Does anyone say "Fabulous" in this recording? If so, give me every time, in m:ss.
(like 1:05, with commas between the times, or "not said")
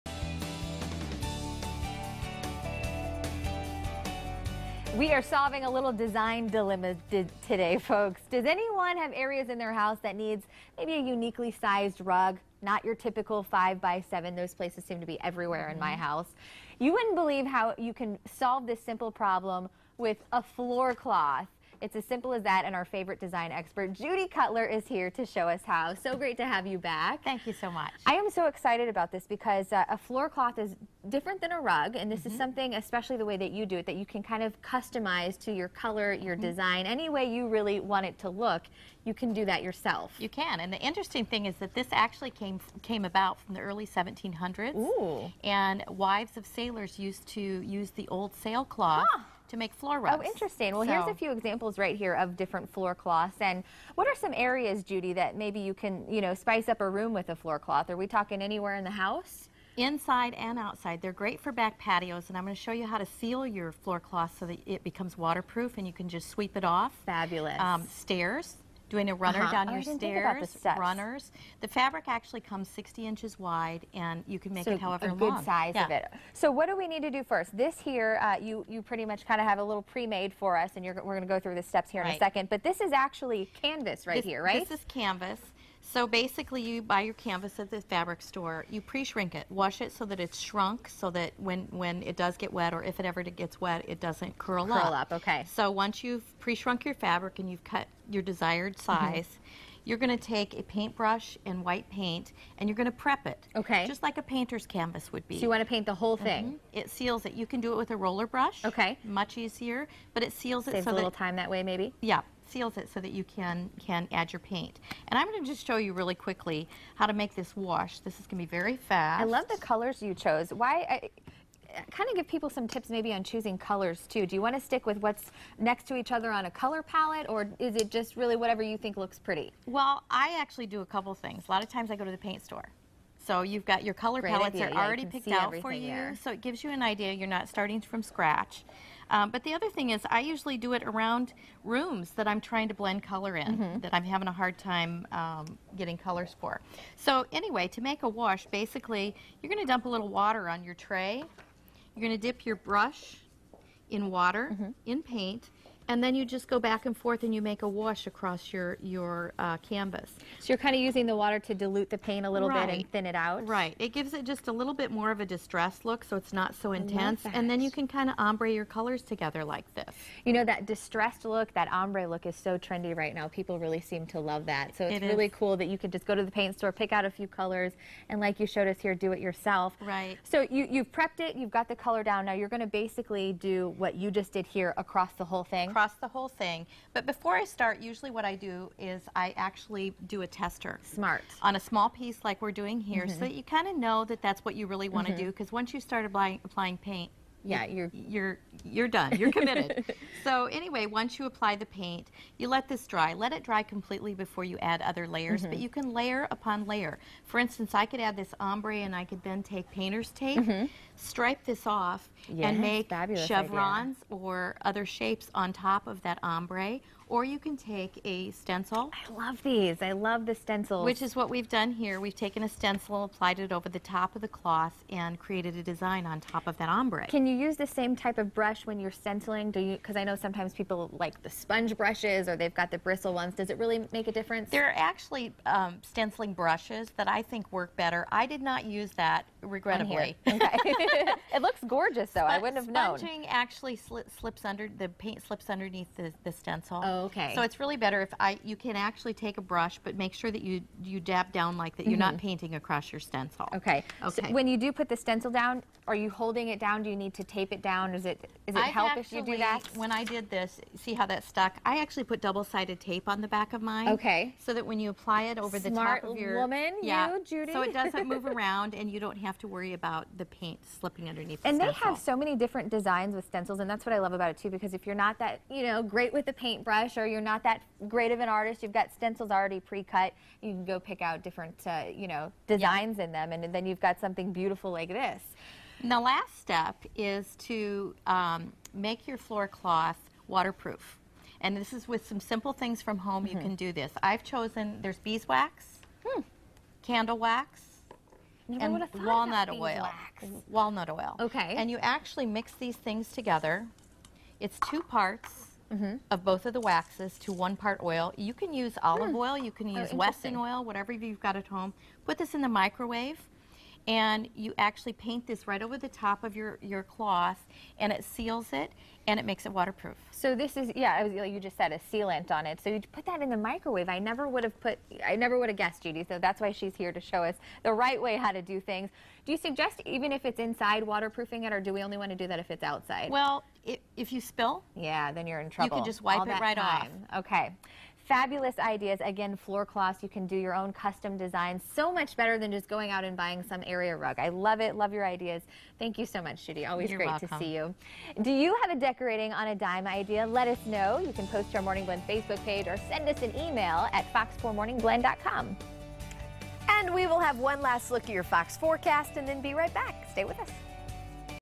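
1:07, 5:38.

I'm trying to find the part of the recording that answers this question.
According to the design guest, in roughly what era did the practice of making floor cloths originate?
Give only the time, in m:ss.
0:43.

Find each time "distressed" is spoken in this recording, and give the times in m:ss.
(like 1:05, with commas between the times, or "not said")
2:45, 2:50.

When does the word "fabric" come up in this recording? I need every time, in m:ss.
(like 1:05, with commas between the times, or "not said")
1:11, 1:27, 1:36.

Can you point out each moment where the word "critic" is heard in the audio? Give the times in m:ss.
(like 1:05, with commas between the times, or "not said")
not said.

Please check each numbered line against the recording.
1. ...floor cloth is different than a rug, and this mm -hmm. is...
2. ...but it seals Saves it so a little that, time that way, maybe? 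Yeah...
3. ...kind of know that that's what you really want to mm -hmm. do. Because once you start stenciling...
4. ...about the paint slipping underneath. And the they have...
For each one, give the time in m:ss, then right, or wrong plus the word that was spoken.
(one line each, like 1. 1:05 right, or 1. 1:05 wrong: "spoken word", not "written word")
1. 0:29 right
2. 1:50 right
3. 3:13 wrong: "applying", not "stenciling"
4. 4:29 right.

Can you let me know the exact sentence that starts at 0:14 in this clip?
Those places seem to be everywhere mm -hmm.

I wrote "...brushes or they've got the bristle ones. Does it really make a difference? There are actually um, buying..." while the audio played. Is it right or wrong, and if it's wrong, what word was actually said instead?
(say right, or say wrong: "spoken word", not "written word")
wrong: "stenciling", not "buying".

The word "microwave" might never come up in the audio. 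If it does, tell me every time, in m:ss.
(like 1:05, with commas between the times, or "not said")
5:12, 5:23.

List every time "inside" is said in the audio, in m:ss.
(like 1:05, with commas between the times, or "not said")
0:59, 5:30.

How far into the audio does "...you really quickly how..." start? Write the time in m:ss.
1:55.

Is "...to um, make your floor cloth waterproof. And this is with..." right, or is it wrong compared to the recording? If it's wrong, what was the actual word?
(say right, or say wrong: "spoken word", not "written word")
right.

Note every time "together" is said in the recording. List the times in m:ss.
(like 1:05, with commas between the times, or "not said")
2:49, 5:03.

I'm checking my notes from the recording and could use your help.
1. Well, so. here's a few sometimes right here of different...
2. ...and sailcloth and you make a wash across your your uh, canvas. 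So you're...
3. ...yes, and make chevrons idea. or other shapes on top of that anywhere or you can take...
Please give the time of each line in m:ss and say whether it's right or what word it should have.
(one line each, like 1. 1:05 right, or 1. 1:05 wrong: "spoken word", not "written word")
1. 0:50 wrong: "examples", not "sometimes"
2. 2:36 wrong: "forth", not "sailcloth"
3. 3:32 wrong: "ombre", not "anywhere".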